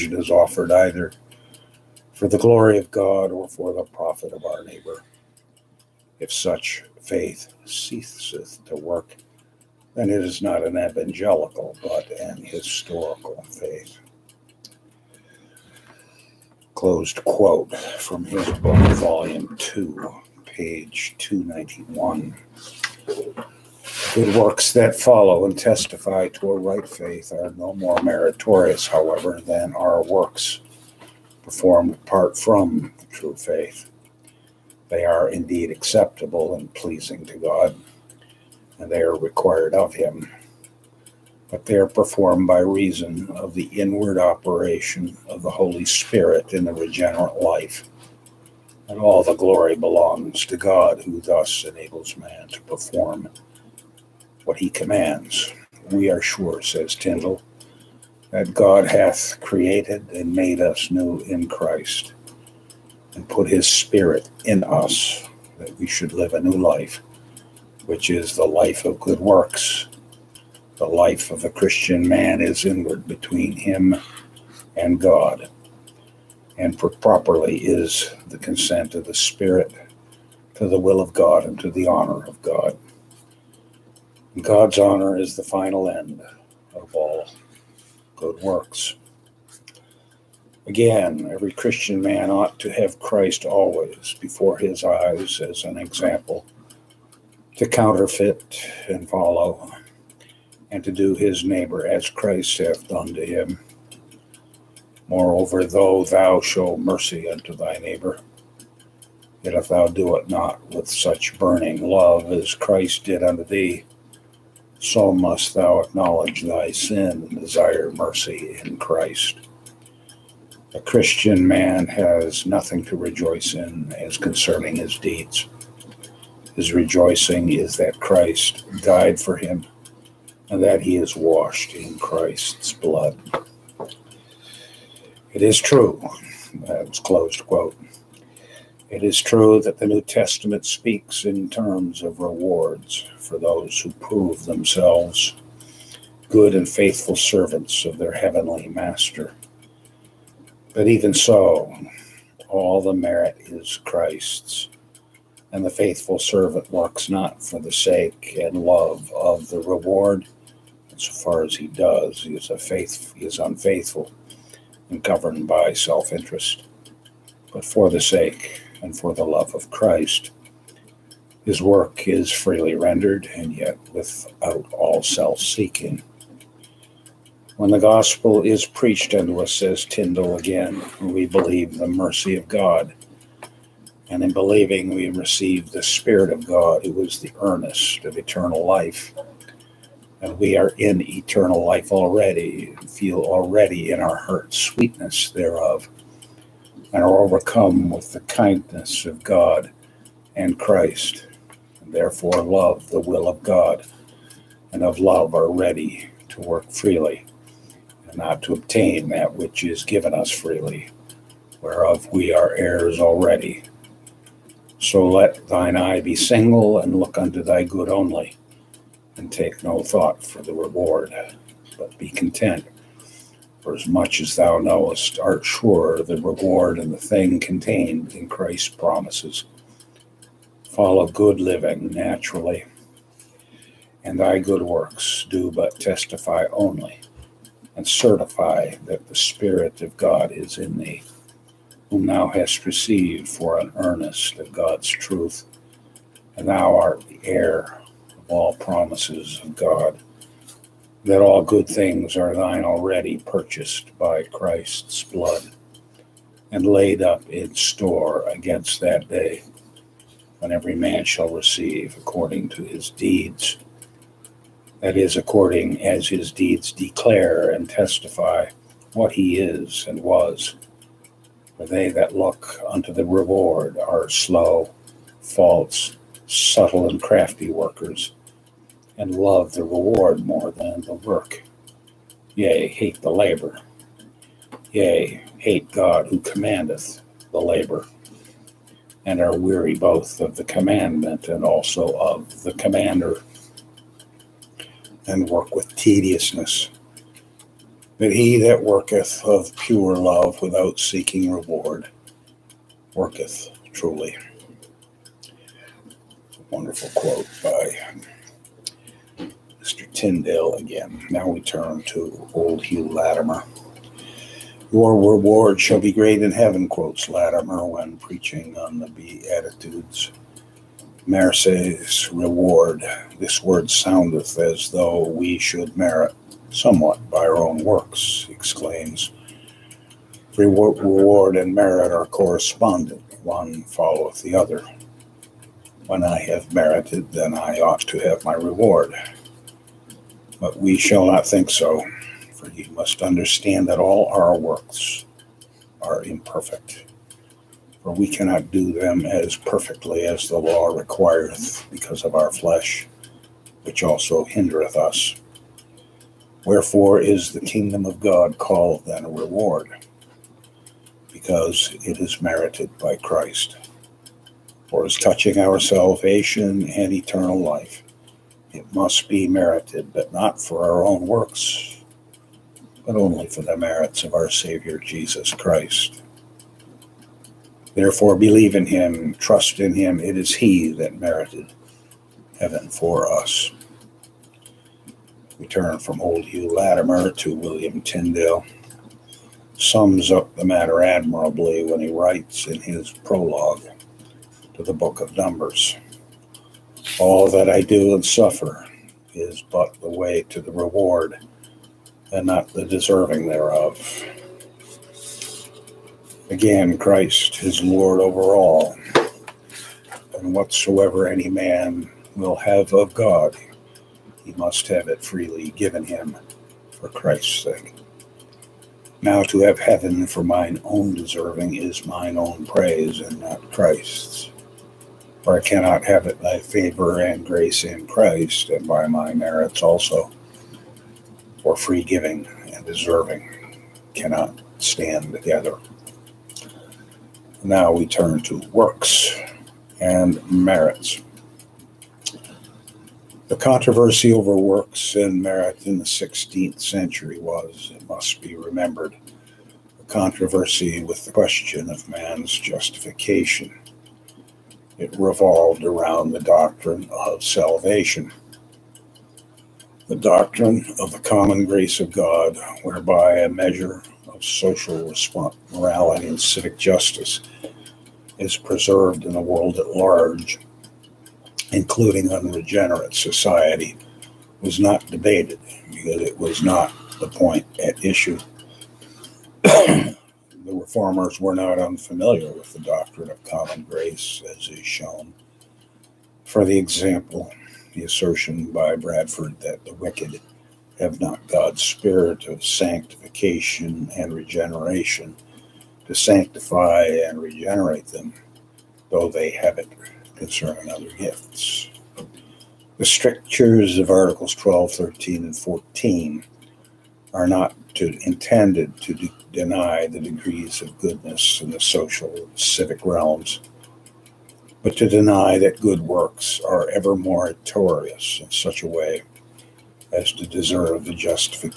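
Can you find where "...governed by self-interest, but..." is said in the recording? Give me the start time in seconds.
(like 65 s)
165 s.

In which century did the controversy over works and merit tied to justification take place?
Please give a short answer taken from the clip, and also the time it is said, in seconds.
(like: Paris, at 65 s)
16th century, at 445 s.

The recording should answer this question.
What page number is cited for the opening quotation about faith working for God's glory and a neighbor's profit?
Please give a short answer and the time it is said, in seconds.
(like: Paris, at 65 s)
291, at 20 s.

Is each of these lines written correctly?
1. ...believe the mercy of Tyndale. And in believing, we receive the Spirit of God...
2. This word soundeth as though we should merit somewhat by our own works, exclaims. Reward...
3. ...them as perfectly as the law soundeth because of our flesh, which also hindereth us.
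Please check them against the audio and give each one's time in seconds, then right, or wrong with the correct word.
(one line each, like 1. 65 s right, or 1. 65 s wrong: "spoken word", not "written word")
1. 181 s wrong: "God", not "Tyndale"
2. 323 s right
3. 348 s wrong: "requireth", not "soundeth".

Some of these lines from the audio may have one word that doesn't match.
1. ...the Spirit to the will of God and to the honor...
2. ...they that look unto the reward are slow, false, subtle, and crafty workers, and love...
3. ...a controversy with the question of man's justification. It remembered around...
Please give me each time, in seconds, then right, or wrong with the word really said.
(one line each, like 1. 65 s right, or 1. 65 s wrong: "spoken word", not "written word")
1. 79 s right
2. 271 s right
3. 449 s wrong: "revolved", not "remembered".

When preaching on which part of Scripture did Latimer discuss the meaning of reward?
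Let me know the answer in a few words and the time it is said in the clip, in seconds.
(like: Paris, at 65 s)
the Beatitudes, at 318 s.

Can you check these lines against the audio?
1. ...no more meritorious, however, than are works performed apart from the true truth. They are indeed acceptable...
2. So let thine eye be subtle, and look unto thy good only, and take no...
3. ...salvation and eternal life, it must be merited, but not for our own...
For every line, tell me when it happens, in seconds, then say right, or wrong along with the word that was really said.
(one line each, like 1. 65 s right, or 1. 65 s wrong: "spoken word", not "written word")
1. 27 s wrong: "faith", not "truth"
2. 214 s wrong: "single", not "subtle"
3. 365 s right.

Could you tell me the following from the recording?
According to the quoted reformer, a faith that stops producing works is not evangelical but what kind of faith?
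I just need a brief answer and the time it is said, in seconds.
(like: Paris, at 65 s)
historical, at 12 s.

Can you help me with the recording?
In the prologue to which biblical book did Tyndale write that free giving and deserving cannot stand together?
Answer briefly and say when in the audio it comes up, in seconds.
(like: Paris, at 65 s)
Numbers, at 395 s.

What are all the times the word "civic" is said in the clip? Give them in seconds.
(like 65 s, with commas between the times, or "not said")
466 s, 512 s.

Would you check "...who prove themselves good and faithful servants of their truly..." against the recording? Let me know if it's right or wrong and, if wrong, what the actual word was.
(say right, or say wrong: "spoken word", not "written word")
wrong: "heavenly", not "truly".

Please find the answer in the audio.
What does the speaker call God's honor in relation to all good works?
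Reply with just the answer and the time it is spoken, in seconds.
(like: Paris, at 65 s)
the final end, at 85 s.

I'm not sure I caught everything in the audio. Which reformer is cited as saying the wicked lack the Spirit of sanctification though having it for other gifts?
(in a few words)
Bradford.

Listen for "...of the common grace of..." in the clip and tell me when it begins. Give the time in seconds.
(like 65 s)
460 s.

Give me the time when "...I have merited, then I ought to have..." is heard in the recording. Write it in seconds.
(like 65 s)
336 s.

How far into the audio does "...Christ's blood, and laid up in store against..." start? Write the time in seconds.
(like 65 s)
254 s.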